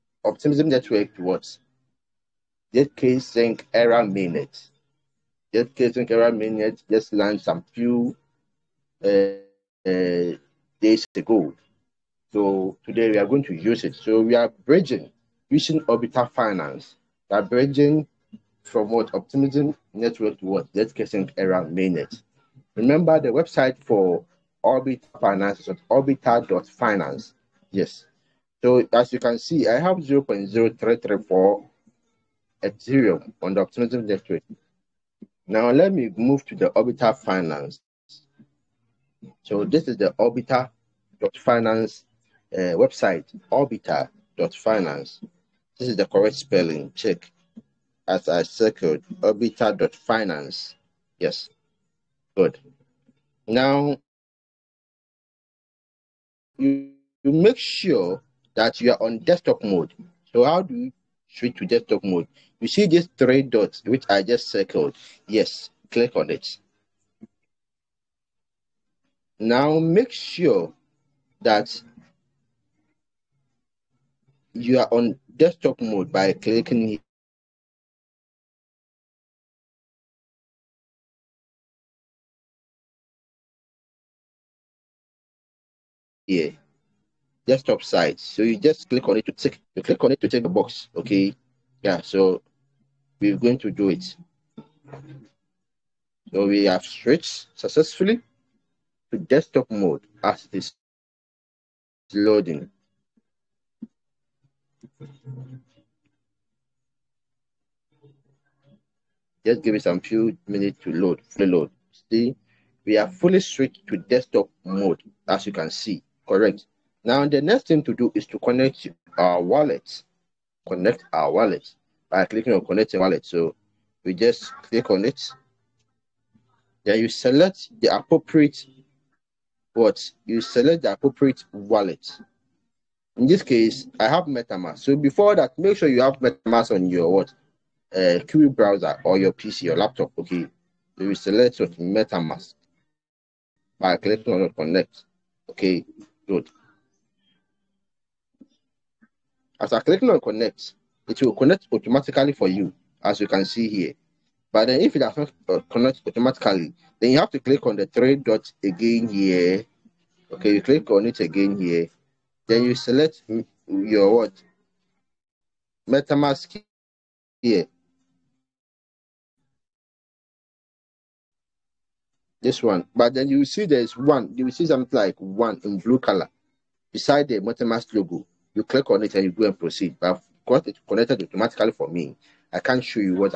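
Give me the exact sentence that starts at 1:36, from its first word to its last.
So we have switched successfully to desktop mode as this is loading.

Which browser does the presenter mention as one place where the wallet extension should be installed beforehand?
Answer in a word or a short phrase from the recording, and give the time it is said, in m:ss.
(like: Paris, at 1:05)
Kiwi browser, at 2:18.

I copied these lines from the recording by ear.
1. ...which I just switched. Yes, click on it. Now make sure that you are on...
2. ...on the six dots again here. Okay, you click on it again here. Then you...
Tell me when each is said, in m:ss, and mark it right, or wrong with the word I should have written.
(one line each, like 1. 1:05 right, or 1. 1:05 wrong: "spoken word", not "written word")
1. 1:03 wrong: "circled", not "switched"
2. 2:37 wrong: "three", not "six".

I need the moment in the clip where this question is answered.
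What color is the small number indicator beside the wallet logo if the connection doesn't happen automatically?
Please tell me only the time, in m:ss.
2:55.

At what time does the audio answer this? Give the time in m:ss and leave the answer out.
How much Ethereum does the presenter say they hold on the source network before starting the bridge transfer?
0:29.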